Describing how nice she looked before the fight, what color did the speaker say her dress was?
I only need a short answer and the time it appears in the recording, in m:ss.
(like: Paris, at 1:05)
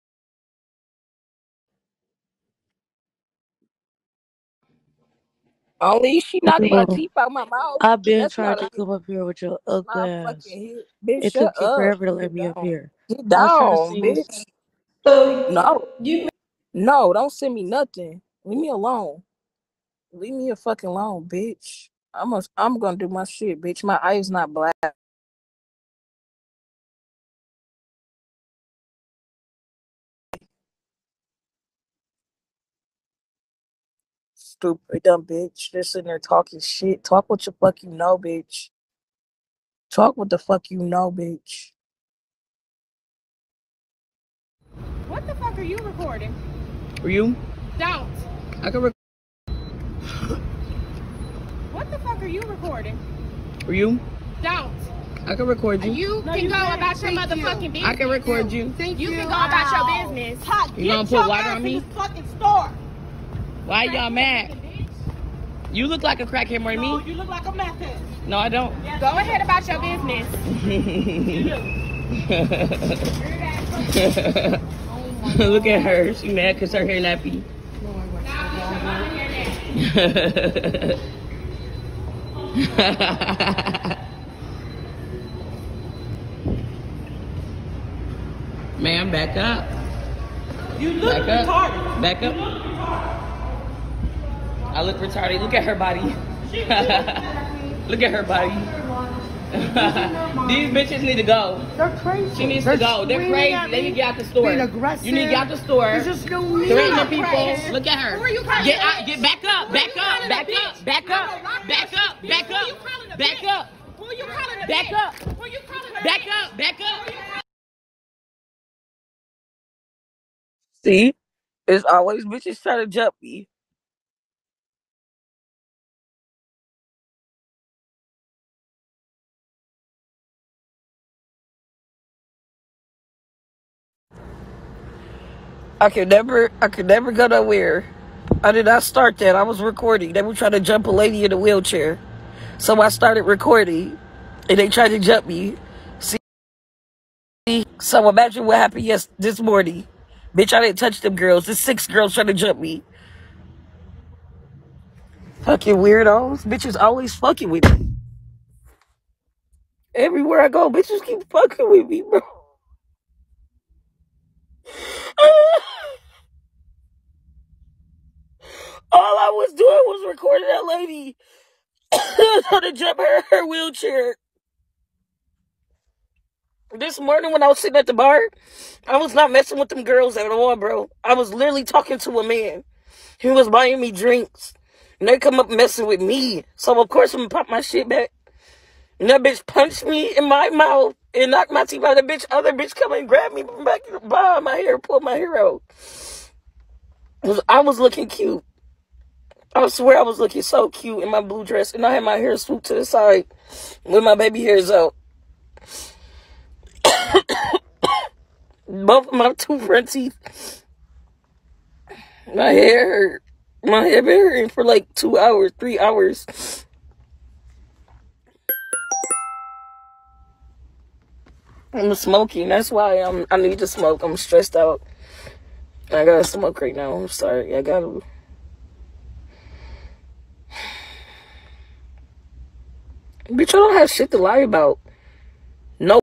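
Blue, at 3:21.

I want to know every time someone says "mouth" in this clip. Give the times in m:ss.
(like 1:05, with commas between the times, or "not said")
0:07, 3:10.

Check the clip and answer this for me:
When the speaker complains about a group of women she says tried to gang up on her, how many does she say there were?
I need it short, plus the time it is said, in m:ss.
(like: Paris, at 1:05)
6, at 2:31.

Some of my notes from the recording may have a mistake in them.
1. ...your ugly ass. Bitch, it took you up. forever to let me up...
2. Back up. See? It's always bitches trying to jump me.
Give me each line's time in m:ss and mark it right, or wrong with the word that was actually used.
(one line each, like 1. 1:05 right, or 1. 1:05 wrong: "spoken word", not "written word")
1. 0:09 right
2. 1:56 right.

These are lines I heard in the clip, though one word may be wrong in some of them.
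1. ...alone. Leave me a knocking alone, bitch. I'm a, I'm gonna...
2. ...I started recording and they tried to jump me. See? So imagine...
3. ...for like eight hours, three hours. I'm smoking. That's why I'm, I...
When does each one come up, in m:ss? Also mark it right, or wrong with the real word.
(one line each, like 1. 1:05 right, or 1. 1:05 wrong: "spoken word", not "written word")
1. 0:18 wrong: "fucking", not "knocking"
2. 2:22 right
3. 3:34 wrong: "two", not "eight".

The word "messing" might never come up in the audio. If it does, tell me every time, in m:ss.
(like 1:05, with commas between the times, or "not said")
2:59, 3:05.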